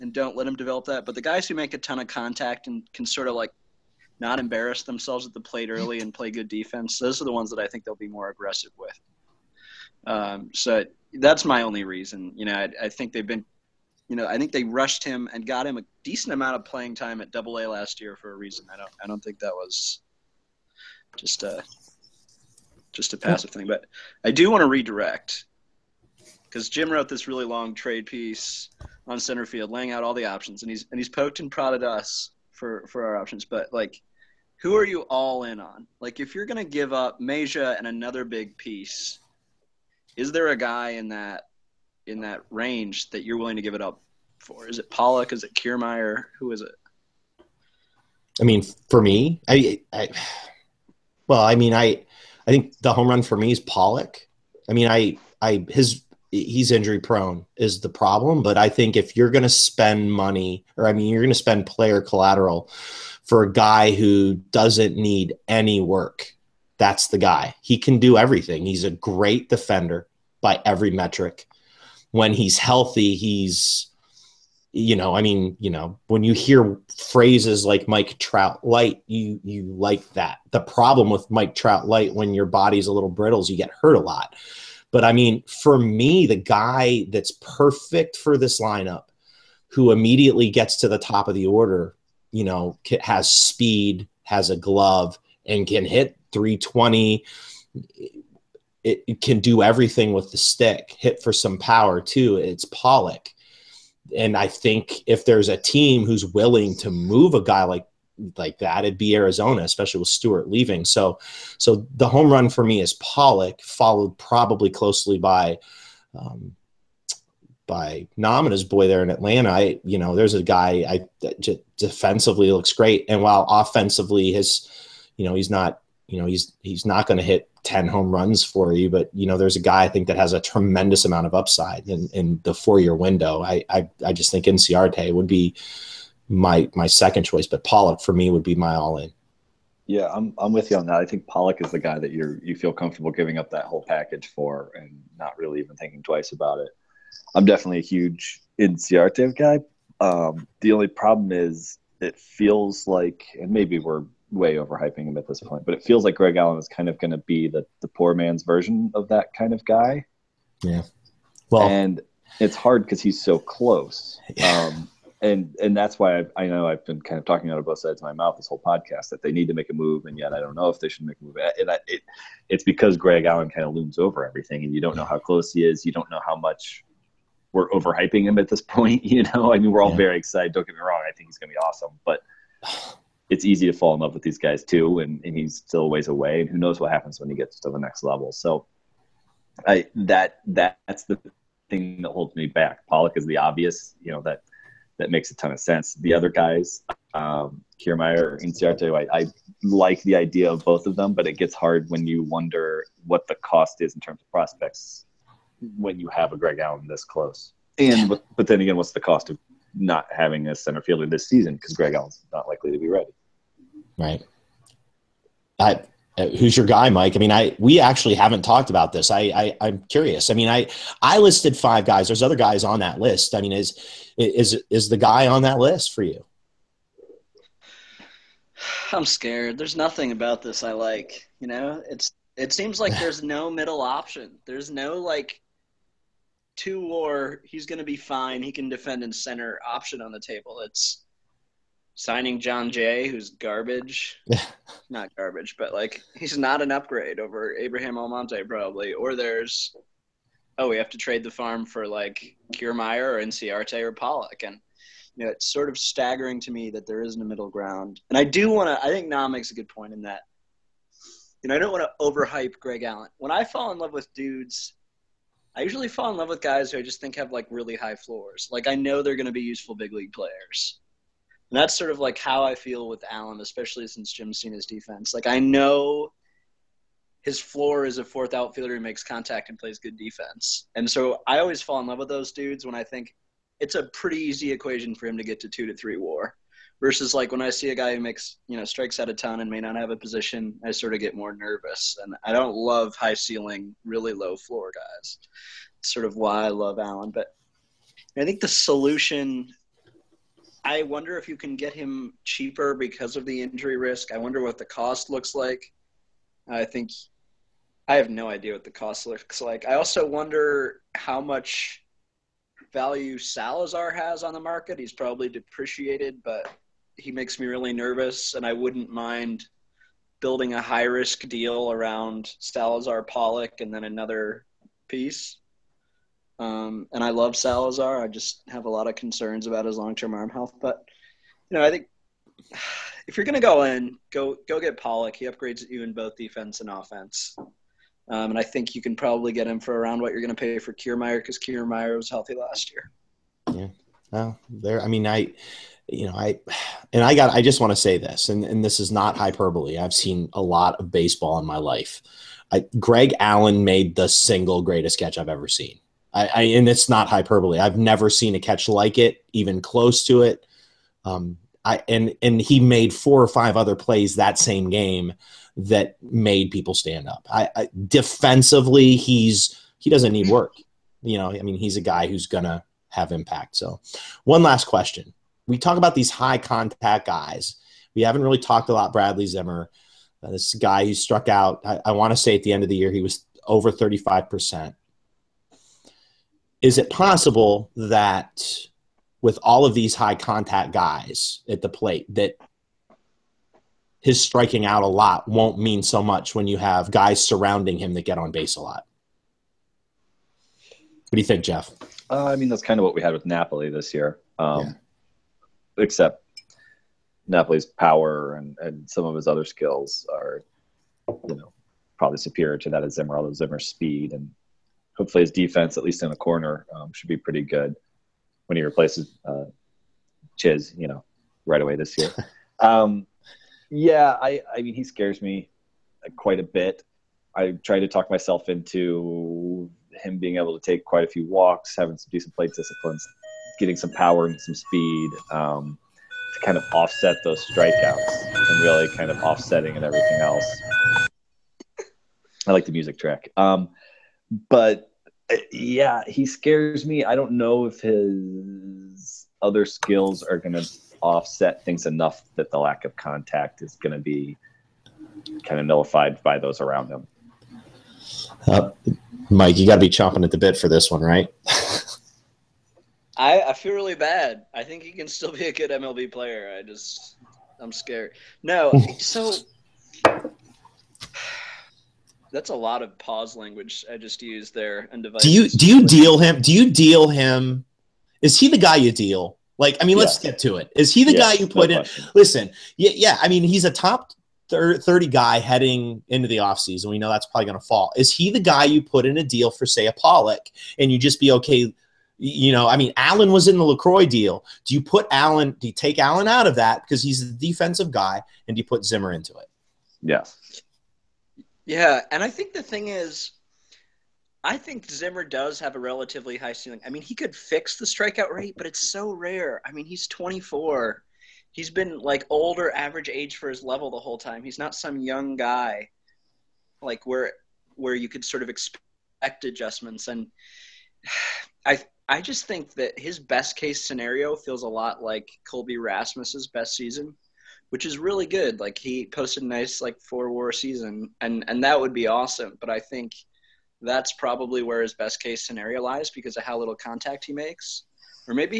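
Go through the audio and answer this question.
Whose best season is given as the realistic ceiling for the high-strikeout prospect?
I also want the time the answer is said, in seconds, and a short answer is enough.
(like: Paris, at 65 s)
Colby Rasmus, at 525 s.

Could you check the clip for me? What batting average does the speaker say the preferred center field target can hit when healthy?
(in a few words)
320.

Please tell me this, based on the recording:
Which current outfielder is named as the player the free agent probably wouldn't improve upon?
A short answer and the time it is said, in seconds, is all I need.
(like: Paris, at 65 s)
Abraham Almonte, at 247 s.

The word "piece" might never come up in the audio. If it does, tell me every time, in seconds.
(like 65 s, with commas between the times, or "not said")
28 s, 38 s, 324 s.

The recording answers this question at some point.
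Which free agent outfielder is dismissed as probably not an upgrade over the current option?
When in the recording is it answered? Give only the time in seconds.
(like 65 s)
242 s.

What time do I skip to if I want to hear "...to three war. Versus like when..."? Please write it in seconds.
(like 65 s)
285 s.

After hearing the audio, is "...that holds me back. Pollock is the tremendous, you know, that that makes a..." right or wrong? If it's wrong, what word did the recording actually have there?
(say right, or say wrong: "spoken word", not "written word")
wrong: "obvious", not "tremendous".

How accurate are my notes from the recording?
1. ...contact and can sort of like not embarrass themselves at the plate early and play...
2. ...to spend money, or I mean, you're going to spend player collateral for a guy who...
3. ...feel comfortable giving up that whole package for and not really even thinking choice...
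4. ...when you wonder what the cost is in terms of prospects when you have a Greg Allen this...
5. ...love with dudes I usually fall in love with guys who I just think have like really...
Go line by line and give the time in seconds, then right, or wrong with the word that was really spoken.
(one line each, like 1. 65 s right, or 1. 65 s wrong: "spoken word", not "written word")
1. 2 s right
2. 59 s right
3. 142 s wrong: "twice", not "choice"
4. 201 s right
5. 263 s right.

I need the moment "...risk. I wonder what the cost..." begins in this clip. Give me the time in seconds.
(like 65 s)
303 s.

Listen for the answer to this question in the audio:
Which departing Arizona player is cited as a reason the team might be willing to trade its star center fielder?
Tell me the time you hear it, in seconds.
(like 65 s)
110 s.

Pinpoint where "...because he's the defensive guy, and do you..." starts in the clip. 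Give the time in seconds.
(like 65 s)
496 s.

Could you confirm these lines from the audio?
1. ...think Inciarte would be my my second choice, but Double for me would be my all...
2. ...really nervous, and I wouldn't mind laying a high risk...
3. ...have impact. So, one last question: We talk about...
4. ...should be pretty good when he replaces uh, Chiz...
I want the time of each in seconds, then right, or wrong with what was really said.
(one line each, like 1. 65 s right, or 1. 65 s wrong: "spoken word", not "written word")
1. 134 s wrong: "Pollock", not "Double"
2. 317 s wrong: "building", not "laying"
3. 372 s right
4. 416 s right.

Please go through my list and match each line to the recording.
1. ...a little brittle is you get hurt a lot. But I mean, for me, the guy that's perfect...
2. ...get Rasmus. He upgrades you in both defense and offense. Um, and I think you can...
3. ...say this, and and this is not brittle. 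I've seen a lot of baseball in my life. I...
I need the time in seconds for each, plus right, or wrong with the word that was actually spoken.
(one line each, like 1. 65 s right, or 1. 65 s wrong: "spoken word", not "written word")
1. 82 s right
2. 334 s wrong: "Pollock", not "Rasmus"
3. 347 s wrong: "hyperbole", not "brittle".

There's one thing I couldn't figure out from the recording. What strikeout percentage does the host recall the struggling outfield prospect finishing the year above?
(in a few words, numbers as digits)
35 percent.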